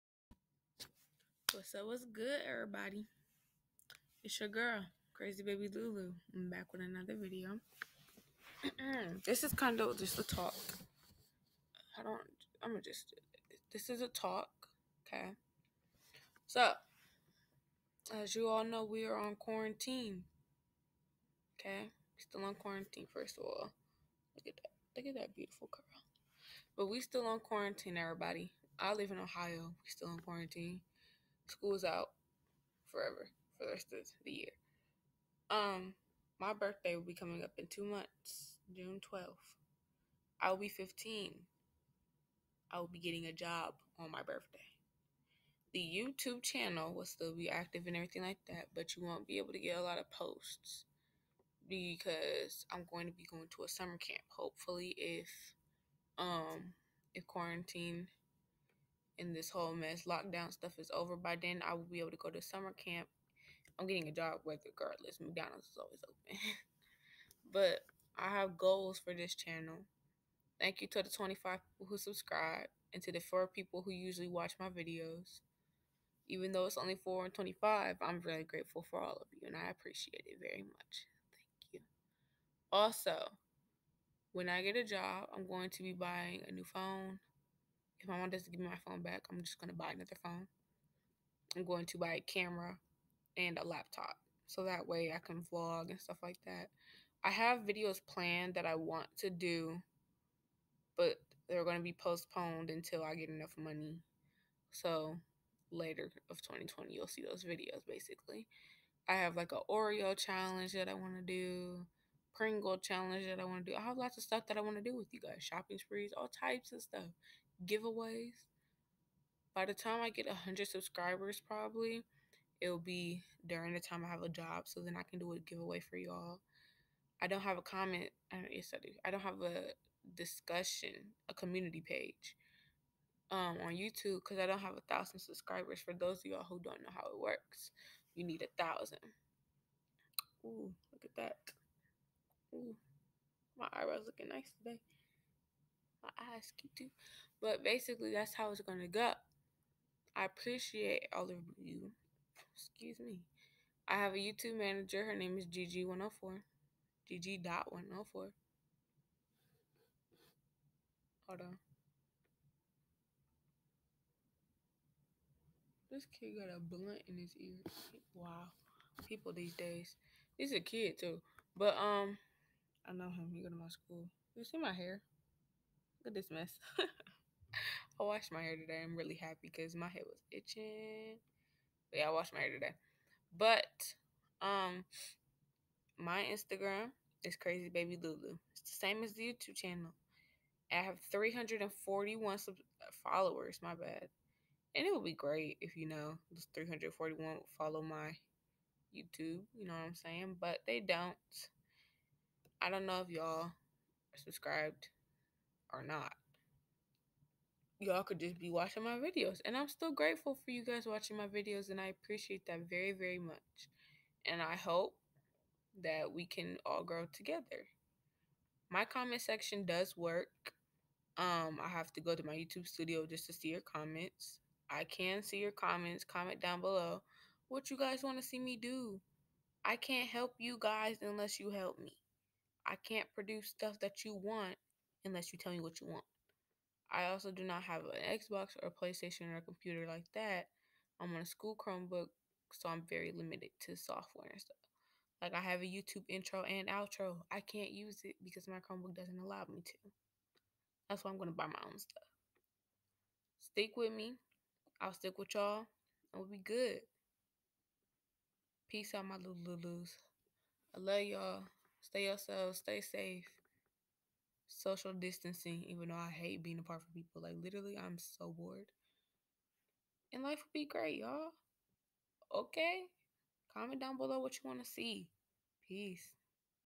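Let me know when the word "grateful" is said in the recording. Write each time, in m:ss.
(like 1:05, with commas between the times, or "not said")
1:18, 3:29.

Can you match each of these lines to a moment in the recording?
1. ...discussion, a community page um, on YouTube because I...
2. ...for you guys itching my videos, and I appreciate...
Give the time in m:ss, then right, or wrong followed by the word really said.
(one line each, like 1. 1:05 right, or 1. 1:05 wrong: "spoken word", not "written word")
1. 2:10 right
2. 3:30 wrong: "watching", not "itching".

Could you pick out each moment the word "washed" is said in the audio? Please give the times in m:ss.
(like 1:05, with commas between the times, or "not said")
2:58, 3:02.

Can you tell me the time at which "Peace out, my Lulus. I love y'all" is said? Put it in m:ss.
4:18.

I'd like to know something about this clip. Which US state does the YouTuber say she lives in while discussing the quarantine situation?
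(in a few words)
Ohio.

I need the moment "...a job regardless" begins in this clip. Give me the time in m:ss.
1:04.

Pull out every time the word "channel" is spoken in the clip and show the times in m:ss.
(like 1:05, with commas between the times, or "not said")
0:46, 1:09, 3:09.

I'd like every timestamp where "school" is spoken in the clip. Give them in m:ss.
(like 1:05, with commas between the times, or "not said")
0:31, 2:53, 4:01.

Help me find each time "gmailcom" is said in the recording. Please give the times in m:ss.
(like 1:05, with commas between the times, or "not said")
not said.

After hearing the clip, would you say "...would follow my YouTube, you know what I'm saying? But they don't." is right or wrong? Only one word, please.
right.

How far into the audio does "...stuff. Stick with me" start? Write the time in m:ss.
4:11.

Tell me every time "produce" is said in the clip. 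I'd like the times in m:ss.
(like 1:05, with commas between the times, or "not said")
3:53.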